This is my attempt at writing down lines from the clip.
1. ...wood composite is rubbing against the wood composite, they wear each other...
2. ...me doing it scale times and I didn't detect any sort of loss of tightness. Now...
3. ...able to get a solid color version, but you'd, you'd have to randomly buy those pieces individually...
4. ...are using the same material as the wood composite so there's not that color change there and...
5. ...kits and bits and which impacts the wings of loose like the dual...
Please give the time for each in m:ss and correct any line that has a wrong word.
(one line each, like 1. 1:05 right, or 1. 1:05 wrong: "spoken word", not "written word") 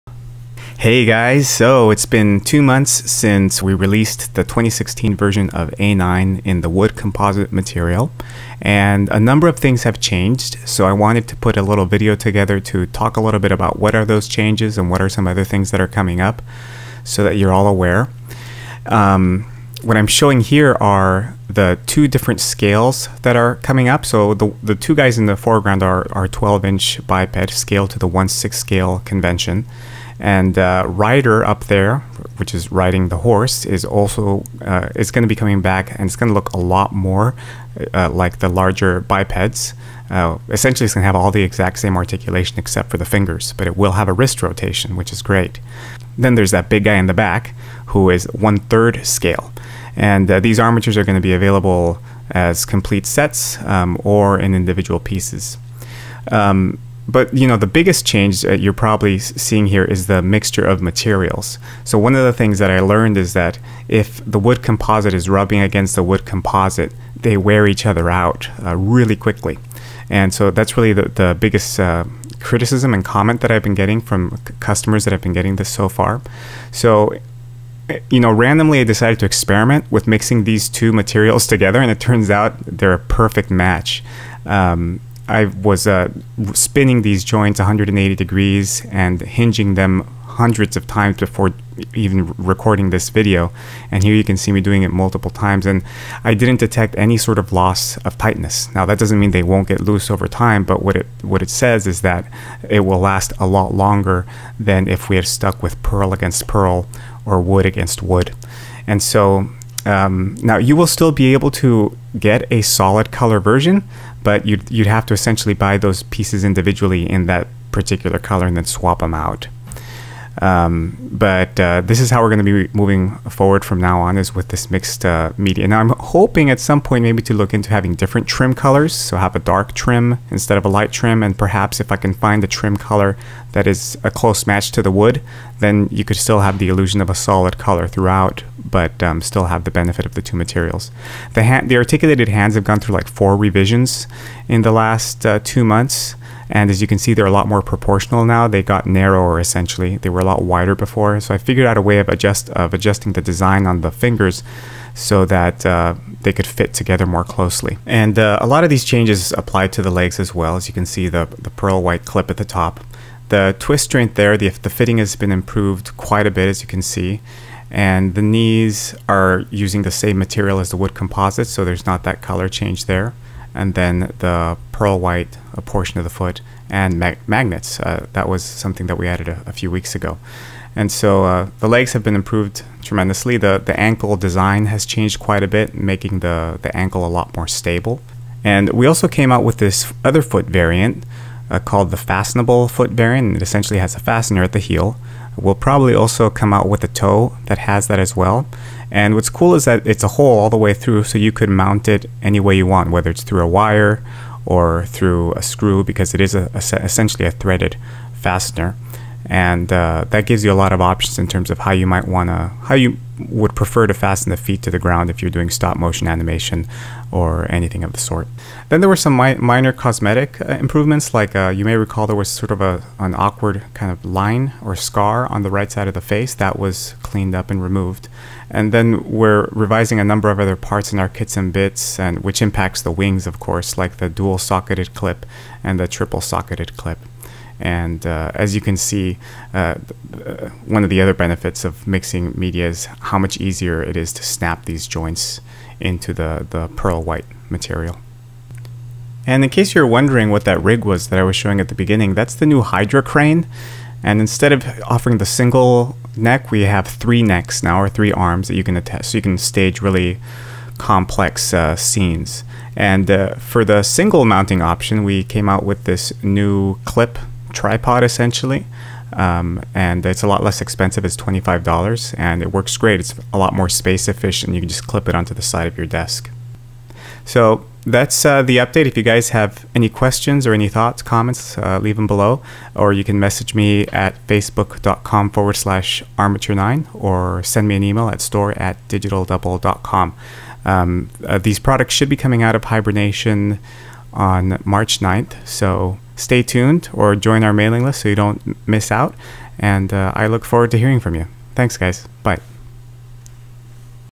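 1. 1:04 right
2. 1:34 wrong: "multiple", not "scale"
3. 1:51 wrong: "essentially", not "randomly"
4. 2:49 right
5. 3:51 wrong: "course", not "loose".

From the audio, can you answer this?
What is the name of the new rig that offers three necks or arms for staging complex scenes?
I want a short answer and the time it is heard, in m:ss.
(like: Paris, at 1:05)
Hydra crane, at 4:12.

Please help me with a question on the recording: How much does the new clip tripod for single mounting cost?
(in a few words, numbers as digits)
$25.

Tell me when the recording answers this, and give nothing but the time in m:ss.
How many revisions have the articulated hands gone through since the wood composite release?
2:23.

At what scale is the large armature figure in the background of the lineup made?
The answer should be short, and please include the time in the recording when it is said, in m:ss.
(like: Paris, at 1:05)
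one third scale, at 0:48.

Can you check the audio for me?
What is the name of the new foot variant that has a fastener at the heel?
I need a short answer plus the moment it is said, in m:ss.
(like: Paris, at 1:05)
fastenable foot bearing, at 3:11.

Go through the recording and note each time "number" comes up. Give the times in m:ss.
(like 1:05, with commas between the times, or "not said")
0:09, 3:50.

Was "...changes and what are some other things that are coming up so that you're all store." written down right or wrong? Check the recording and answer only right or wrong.
wrong.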